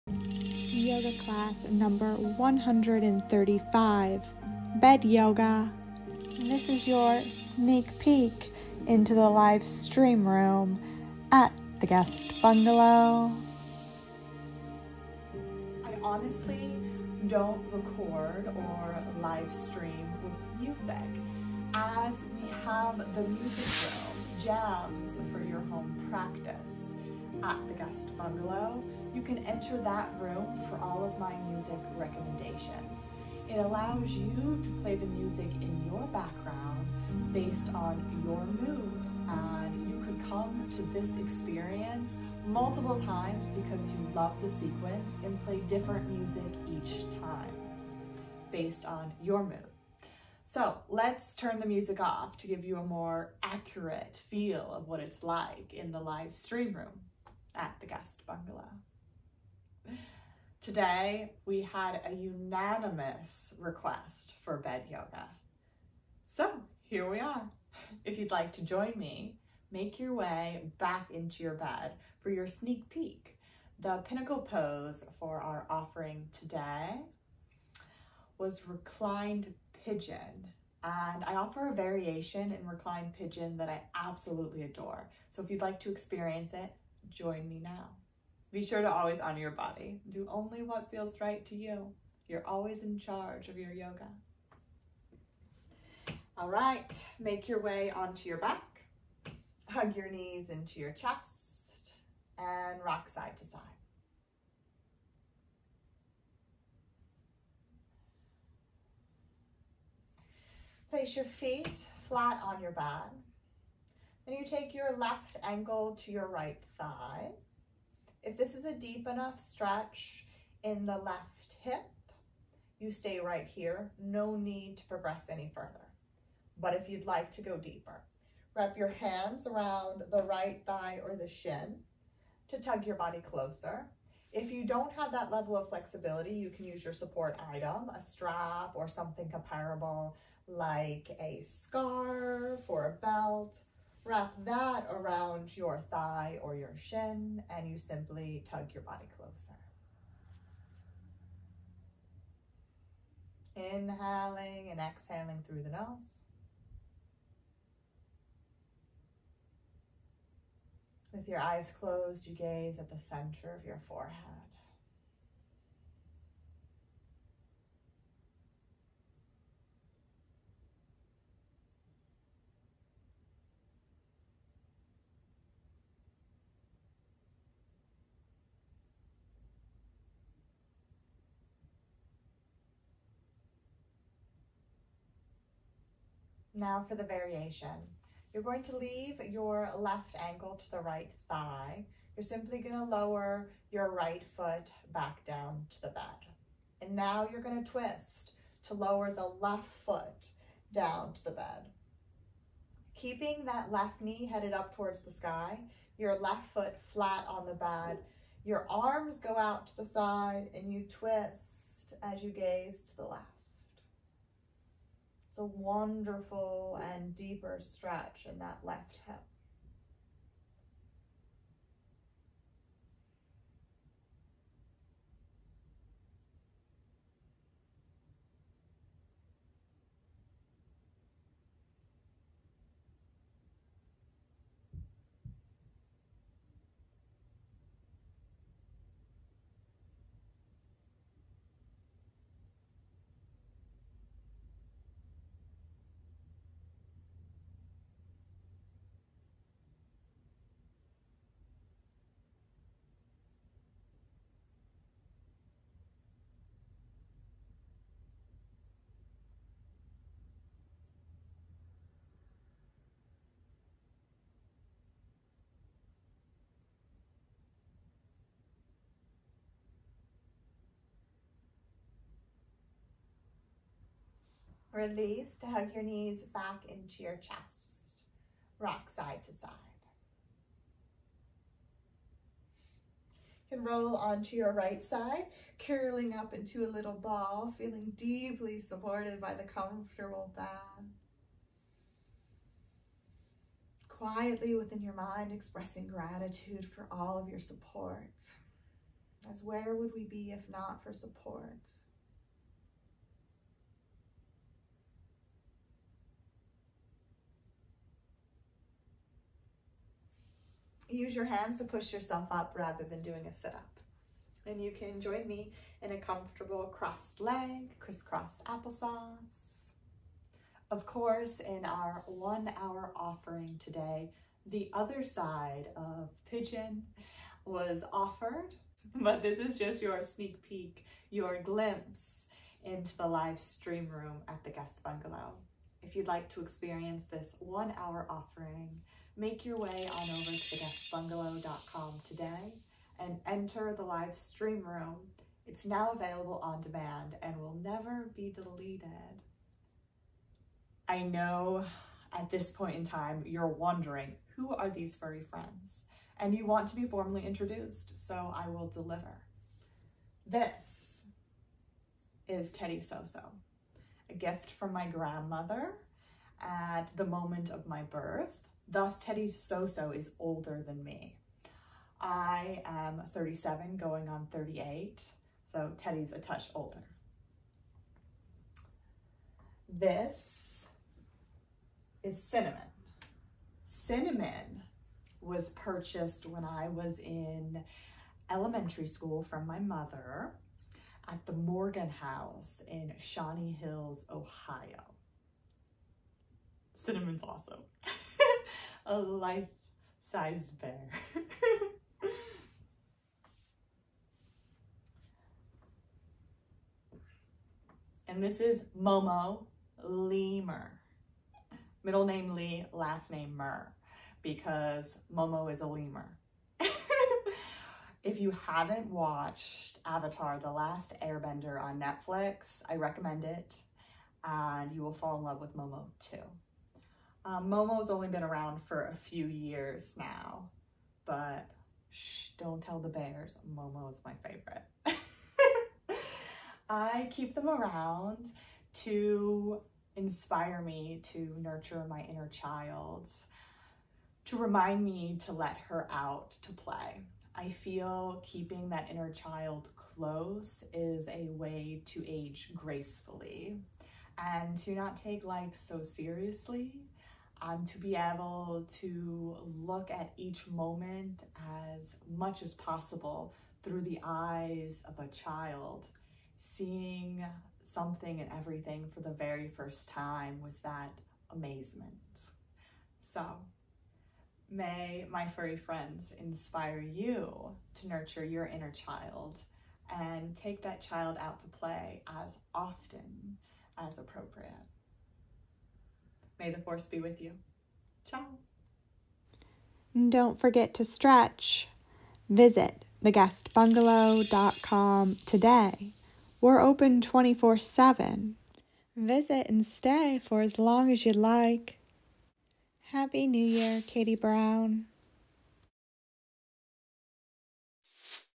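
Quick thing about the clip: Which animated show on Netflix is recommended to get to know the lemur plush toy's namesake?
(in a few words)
Avatar, The Last Airbender.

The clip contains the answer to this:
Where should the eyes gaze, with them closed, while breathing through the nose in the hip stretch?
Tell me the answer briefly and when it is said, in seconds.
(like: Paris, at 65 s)
Center of your forehead, at 162 s.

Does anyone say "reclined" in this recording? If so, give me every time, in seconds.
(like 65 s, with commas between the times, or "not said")
78 s, 82 s.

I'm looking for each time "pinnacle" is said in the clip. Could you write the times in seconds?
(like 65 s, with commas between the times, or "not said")
74 s.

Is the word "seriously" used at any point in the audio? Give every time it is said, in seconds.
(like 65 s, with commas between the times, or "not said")
455 s.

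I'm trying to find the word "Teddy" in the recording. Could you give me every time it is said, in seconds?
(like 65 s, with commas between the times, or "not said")
362 s, 368 s, 375 s.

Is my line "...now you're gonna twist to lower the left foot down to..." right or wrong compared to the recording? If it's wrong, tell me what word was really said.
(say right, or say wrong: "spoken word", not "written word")
right.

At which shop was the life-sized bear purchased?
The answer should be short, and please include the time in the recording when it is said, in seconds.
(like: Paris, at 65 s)
The Morgan House, at 391 s.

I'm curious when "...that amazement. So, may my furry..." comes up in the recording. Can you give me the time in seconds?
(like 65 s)
470 s.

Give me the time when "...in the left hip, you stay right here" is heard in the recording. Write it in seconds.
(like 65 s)
120 s.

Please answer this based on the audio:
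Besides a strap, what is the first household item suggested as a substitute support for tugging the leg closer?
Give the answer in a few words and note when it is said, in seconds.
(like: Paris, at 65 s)
A scarf, at 141 s.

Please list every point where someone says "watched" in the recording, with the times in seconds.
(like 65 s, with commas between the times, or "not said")
418 s.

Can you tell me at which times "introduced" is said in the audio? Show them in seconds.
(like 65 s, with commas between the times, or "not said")
357 s.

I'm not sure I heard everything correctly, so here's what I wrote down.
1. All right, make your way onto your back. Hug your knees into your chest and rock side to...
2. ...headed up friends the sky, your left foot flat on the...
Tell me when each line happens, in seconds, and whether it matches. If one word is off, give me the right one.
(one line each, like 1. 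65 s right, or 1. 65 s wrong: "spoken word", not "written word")
1. 96 s right
2. 204 s wrong: "towards", not "friends".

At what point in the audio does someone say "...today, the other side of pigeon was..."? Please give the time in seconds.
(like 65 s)
323 s.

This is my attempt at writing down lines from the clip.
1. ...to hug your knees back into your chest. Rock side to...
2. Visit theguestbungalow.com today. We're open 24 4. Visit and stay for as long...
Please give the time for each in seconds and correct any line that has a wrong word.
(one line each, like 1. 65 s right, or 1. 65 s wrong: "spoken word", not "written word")
1. 275 s right
2. 492 s wrong: "7", not "4".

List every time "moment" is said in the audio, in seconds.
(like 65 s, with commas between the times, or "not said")
367 s, 460 s.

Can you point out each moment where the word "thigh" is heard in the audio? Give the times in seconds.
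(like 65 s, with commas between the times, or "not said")
116 s, 130 s, 145 s, 191 s.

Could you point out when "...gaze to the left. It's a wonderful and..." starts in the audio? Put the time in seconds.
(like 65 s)
212 s.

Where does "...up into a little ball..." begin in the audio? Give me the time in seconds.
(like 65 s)
286 s.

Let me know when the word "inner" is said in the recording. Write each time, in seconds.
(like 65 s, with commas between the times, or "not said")
442 s, 448 s, 478 s.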